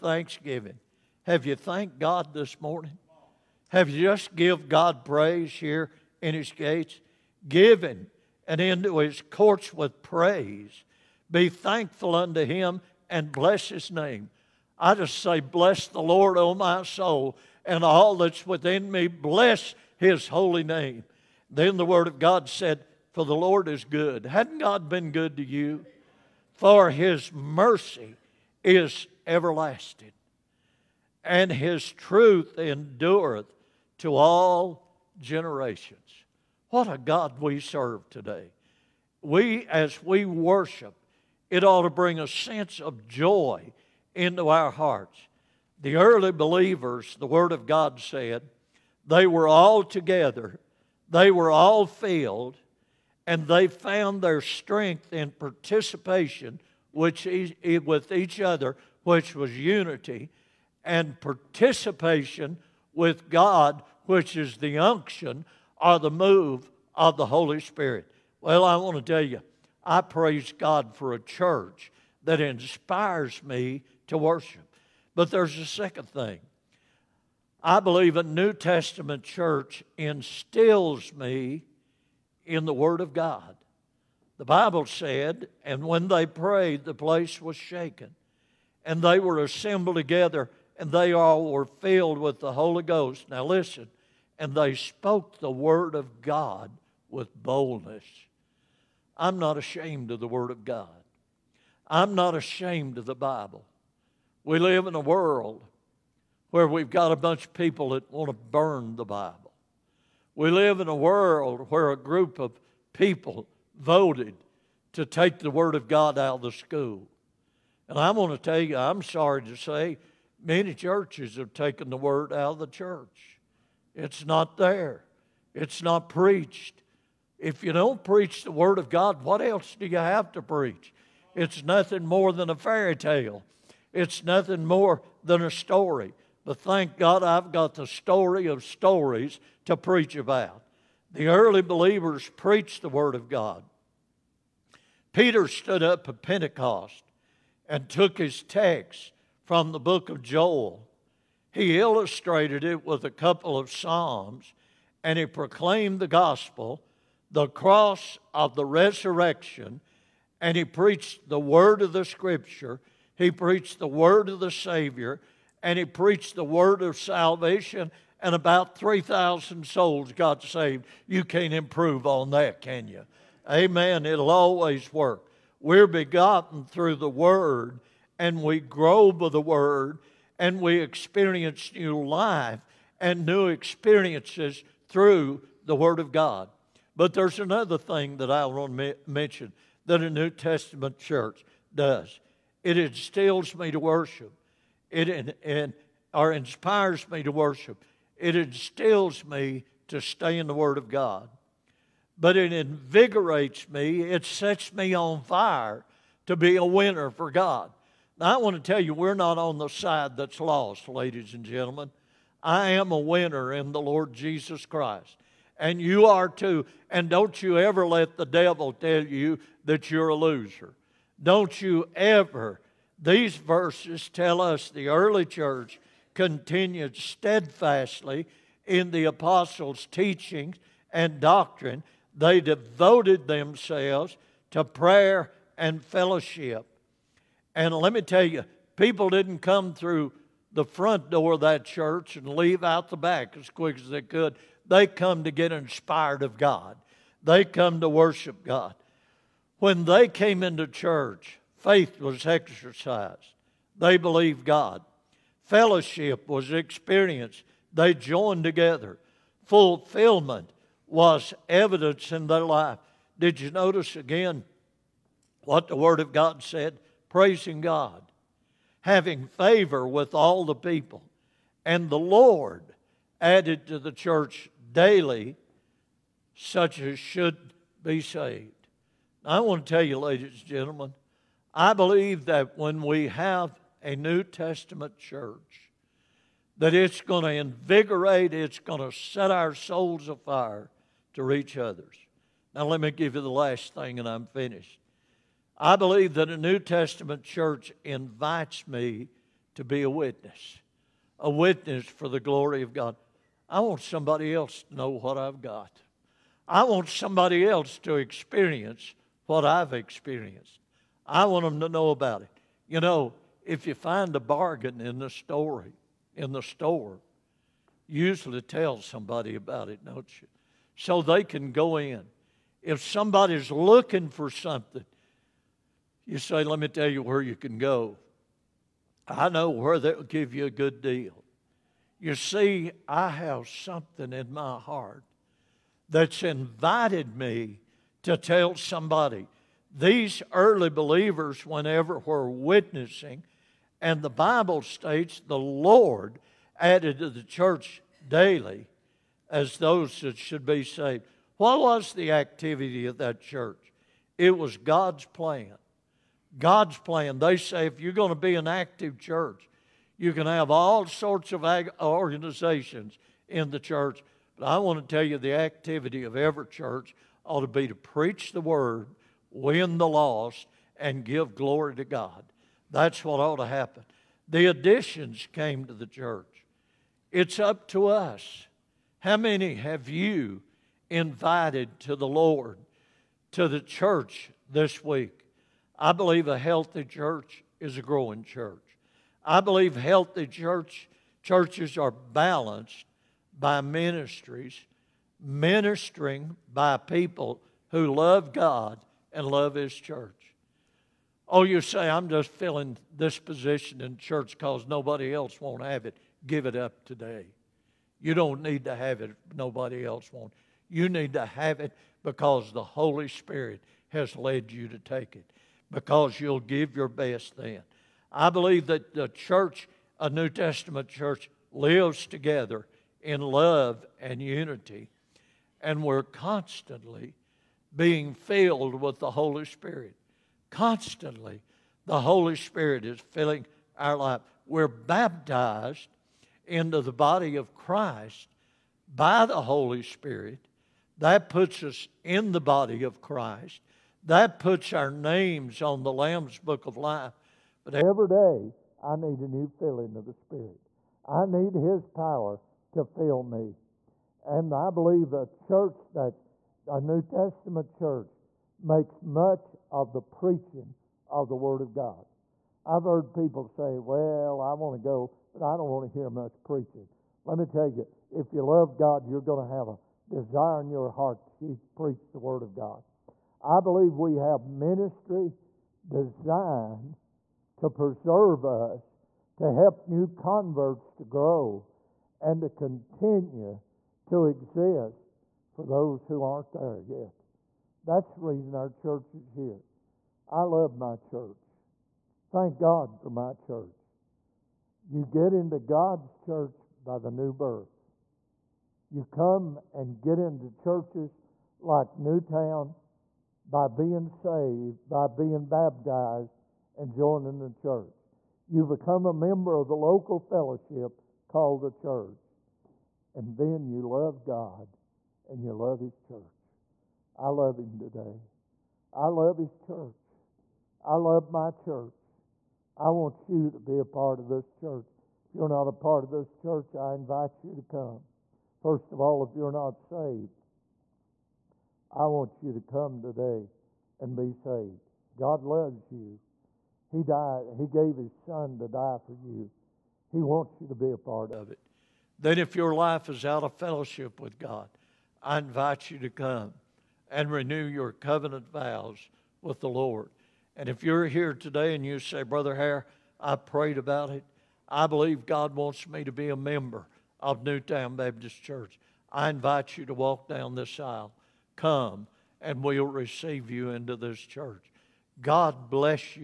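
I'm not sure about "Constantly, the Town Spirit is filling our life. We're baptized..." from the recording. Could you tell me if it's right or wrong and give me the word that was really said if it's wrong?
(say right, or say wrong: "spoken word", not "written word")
wrong: "Holy", not "Town".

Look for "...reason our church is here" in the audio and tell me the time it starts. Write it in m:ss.
8:08.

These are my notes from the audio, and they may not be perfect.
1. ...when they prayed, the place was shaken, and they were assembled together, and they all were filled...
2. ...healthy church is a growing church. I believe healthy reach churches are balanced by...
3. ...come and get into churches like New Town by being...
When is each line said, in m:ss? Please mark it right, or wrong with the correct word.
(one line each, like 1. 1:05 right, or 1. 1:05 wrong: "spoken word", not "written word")
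1. 1:25 right
2. 6:26 wrong: "church", not "reach"
3. 8:19 right.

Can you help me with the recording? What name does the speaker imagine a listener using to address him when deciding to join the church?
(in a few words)
Brother Hare.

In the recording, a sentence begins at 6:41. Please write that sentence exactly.
Oh, you say, I'm just filling this position in church because nobody else won't have it.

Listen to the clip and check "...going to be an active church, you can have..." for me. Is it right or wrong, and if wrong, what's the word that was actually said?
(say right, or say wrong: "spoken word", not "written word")
right.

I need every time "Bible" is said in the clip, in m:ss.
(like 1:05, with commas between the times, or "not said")
1:24, 1:43, 1:49, 5:44.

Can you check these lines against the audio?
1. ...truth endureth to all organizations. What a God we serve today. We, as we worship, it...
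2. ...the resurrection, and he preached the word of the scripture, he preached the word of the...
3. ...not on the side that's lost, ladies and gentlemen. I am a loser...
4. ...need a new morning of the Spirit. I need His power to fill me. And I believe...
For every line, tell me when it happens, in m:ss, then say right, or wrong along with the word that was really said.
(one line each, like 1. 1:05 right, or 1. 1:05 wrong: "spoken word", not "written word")
1. 0:31 wrong: "generations", not "organizations"
2. 2:38 right
3. 3:29 wrong: "winner", not "loser"
4. 7:28 wrong: "filling", not "morning".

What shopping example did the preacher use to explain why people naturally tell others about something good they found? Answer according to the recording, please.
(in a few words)
A bargain.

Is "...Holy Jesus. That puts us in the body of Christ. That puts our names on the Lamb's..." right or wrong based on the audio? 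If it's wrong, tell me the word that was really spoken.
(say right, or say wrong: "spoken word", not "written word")
wrong: "Spirit", not "Jesus".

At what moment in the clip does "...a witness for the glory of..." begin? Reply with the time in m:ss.
5:01.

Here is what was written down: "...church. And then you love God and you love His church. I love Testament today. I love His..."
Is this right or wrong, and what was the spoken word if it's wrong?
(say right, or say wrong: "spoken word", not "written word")
wrong: "Him", not "Testament".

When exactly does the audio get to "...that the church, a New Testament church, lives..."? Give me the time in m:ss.
6:58.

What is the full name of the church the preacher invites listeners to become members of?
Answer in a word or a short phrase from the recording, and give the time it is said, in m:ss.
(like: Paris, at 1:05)
New Town Baptist Church, at 9:17.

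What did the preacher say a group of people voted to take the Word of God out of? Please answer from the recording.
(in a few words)
The school.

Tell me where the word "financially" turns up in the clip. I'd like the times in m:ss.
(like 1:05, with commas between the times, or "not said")
not said.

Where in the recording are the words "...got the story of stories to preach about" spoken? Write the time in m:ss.
2:17.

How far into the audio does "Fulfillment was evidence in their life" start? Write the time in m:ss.
4:19.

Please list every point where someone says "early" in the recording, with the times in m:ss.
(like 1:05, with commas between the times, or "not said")
0:45, 2:21, 3:44, 5:40.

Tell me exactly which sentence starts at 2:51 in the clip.
You can't improve on that, can you?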